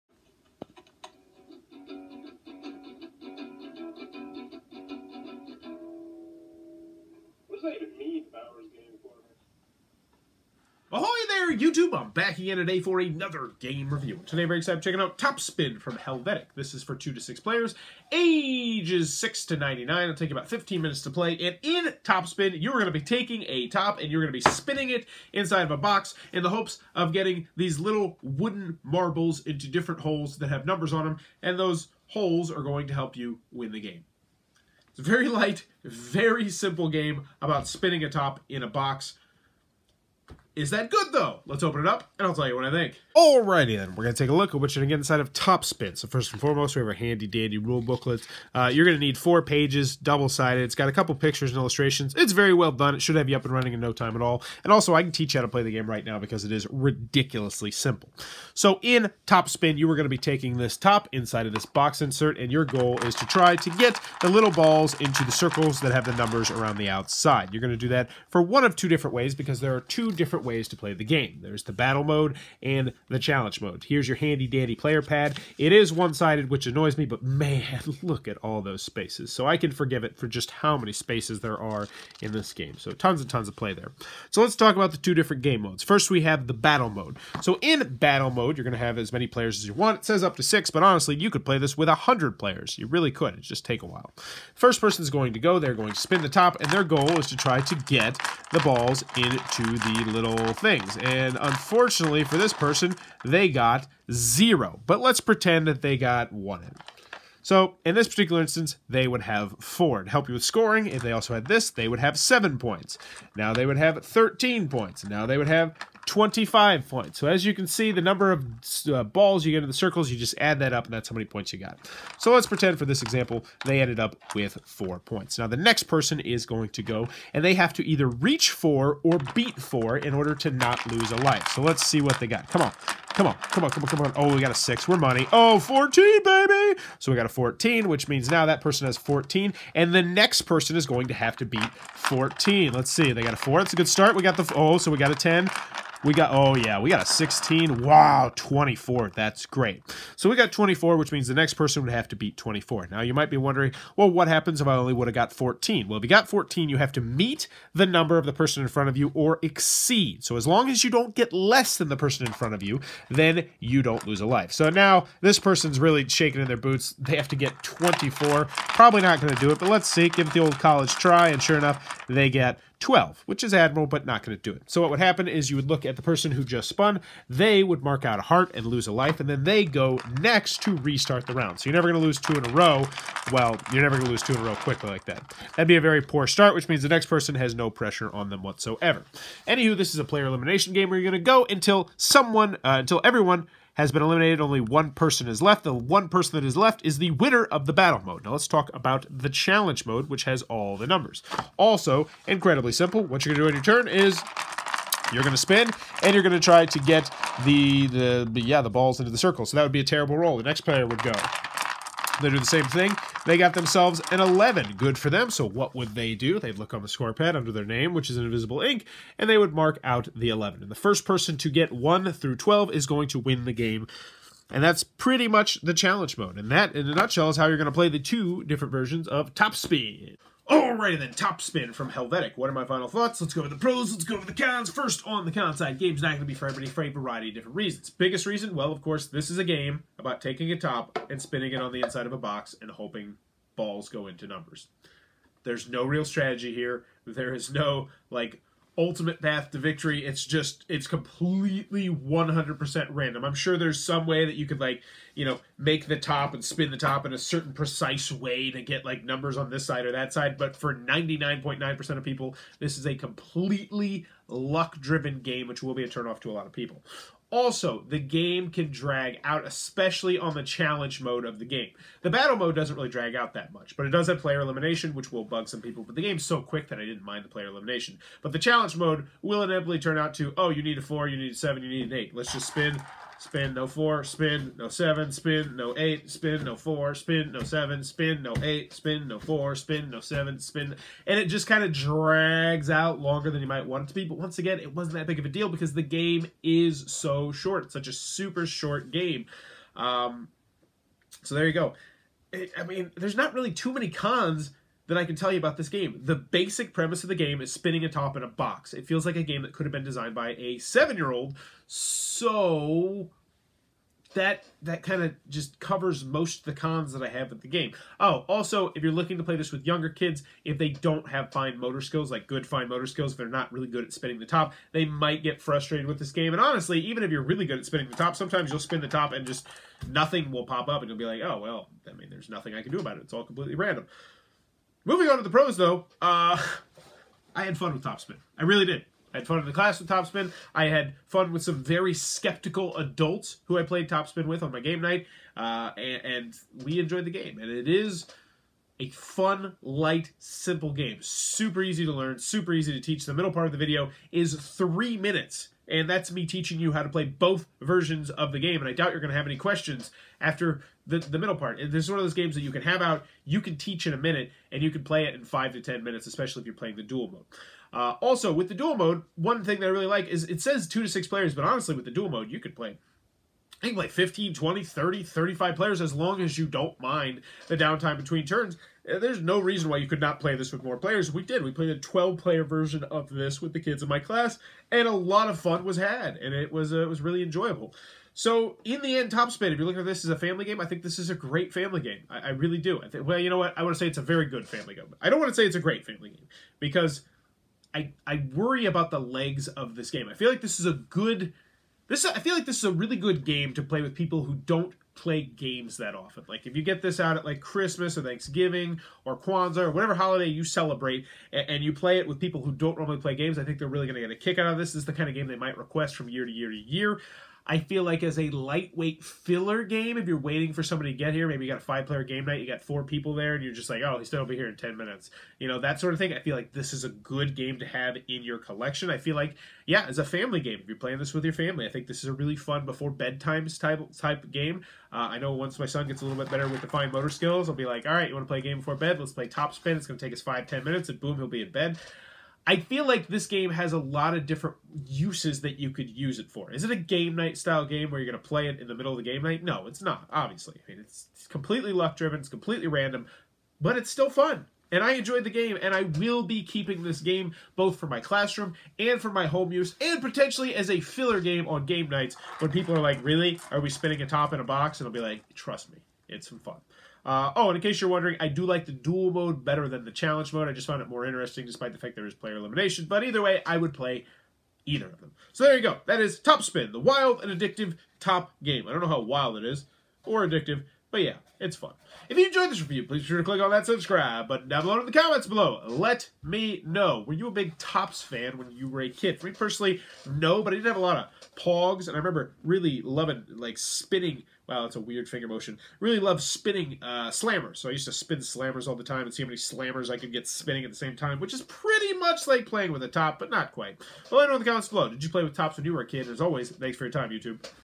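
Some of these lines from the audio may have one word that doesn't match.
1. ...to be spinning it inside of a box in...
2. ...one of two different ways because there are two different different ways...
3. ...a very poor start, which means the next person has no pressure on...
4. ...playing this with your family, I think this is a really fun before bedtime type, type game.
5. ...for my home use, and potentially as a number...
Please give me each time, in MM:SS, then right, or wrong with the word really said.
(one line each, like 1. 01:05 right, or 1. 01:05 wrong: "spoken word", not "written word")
1. 00:24 right
2. 01:08 right
3. 03:05 right
4. 07:10 right
5. 07:39 wrong: "filler", not "number".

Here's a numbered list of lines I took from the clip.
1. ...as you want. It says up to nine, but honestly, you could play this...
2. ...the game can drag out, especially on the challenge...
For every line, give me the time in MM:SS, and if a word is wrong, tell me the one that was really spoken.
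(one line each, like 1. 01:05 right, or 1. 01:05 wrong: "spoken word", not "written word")
1. 01:29 wrong: "six", not "nine"
2. 04:27 right.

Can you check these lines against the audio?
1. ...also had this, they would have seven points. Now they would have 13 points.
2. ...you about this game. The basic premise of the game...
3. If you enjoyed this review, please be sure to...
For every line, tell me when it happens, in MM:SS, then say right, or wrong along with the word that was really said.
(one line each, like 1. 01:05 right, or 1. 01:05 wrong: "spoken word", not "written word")
1. 01:51 right
2. 05:05 right
3. 08:02 right.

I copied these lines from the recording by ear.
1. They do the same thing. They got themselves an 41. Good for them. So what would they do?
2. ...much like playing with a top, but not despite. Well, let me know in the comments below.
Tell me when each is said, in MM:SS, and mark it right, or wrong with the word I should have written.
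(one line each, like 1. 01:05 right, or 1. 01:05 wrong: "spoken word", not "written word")
1. 03:32 wrong: "11", not "41"
2. 08:21 wrong: "quite", not "despite".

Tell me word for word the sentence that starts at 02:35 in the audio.
Well, if you got 14, you have to meet the number of the person in front of you or exceed.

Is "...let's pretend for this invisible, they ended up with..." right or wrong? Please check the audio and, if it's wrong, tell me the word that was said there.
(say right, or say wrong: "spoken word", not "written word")
wrong: "example", not "invisible".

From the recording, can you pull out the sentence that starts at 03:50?
Alrighty then, Top Spin from Helvetiq.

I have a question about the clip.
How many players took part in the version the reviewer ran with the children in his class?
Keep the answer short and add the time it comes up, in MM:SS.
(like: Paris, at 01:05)
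12, at 06:21.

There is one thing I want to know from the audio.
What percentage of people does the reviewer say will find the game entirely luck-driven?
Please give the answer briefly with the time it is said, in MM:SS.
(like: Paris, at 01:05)
99.9%, at 04:20.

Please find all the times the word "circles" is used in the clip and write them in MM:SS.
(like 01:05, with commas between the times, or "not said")
01:05, 01:59, 03:29.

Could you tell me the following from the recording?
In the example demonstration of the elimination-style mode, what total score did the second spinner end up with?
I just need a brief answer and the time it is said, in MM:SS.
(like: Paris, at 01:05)
14, at 02:15.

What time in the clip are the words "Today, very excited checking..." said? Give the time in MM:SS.
00:14.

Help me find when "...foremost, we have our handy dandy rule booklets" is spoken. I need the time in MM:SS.
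00:46.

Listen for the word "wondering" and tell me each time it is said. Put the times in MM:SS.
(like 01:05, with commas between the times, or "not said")
02:33, 07:47.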